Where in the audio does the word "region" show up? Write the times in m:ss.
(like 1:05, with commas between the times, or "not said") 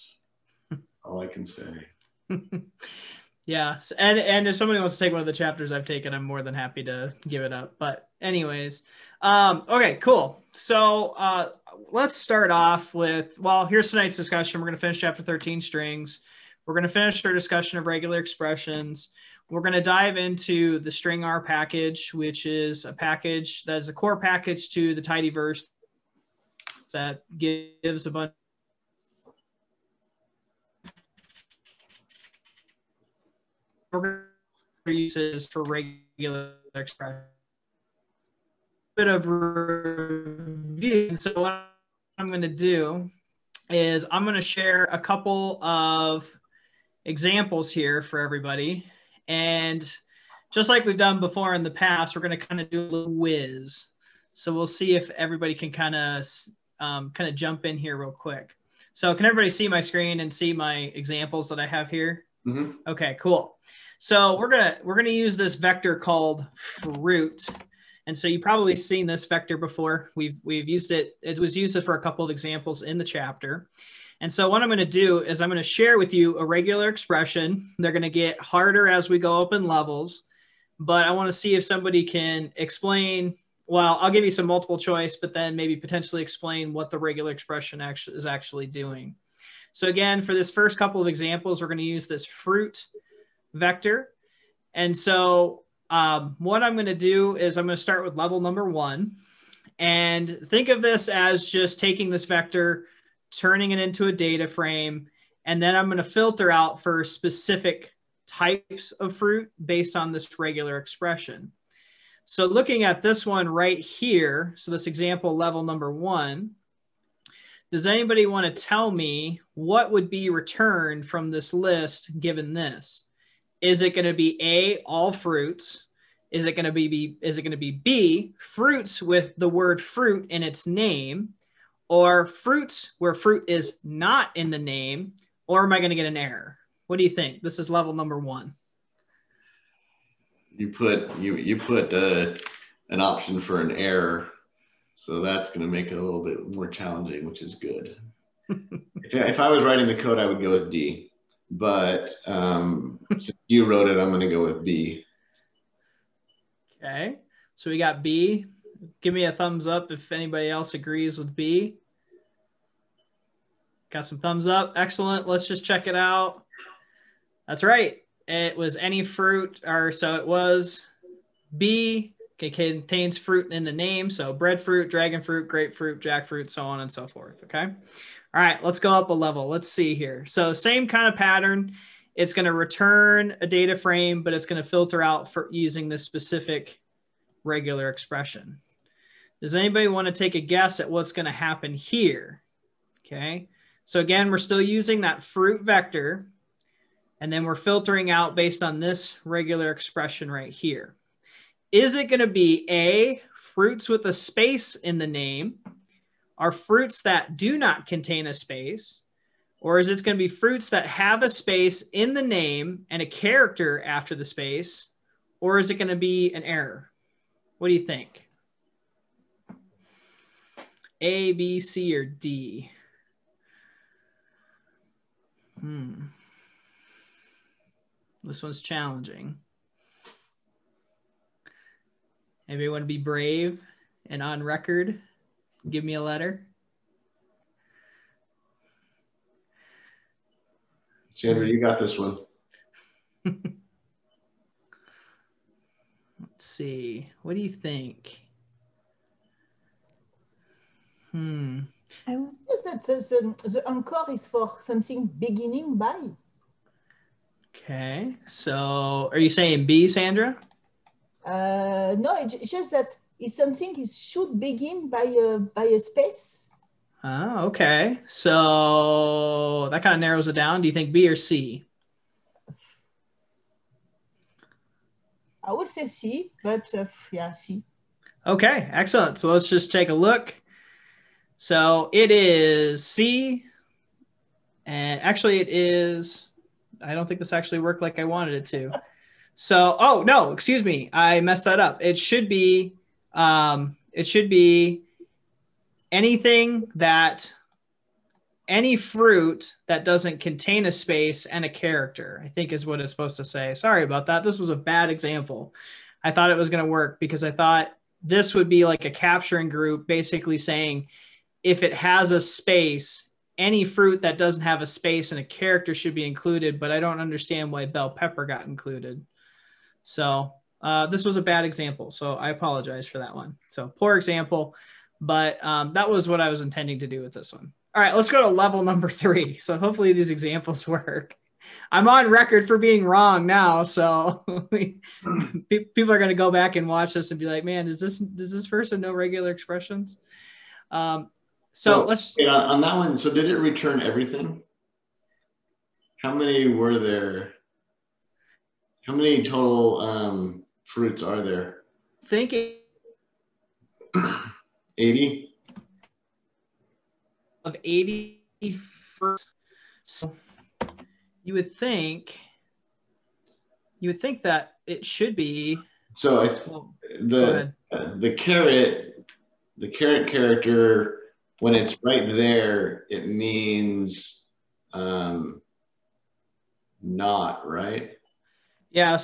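not said.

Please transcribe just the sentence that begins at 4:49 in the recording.
So, oh no, excuse me, I messed that up.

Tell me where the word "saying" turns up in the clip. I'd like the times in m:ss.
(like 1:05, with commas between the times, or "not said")
4:19, 5:10.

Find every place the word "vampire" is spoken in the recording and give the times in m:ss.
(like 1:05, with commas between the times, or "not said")
not said.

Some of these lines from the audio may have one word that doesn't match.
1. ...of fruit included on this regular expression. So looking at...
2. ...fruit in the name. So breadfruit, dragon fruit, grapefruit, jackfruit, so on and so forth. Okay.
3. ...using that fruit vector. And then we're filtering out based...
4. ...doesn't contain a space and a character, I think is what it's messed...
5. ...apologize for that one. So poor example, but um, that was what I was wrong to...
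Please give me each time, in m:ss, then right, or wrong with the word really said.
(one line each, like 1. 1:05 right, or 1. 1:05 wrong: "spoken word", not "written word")
1. 1:48 wrong: "based", not "included"
2. 2:53 right
3. 3:14 right
4. 4:59 wrong: "supposed", not "messed"
5. 5:22 wrong: "intending", not "wrong".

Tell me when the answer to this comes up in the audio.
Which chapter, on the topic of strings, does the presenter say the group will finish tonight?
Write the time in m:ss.
0:14.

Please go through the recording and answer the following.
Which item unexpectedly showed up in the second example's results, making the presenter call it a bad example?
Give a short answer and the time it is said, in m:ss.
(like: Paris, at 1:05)
bell pepper, at 5:17.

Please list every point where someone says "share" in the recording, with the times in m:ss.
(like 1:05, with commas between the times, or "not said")
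0:44, 1:15.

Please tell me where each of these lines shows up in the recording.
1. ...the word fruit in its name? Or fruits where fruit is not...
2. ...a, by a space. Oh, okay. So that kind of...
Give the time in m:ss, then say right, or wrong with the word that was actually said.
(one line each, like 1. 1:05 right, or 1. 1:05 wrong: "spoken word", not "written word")
1. 2:09 right
2. 4:25 right.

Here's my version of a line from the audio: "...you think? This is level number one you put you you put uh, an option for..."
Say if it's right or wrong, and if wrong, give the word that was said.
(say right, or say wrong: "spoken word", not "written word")
right.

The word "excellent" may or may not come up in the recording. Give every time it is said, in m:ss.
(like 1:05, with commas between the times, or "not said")
2:44, 4:38.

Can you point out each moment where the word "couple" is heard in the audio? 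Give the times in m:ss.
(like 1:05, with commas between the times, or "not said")
0:44, 1:12, 1:30.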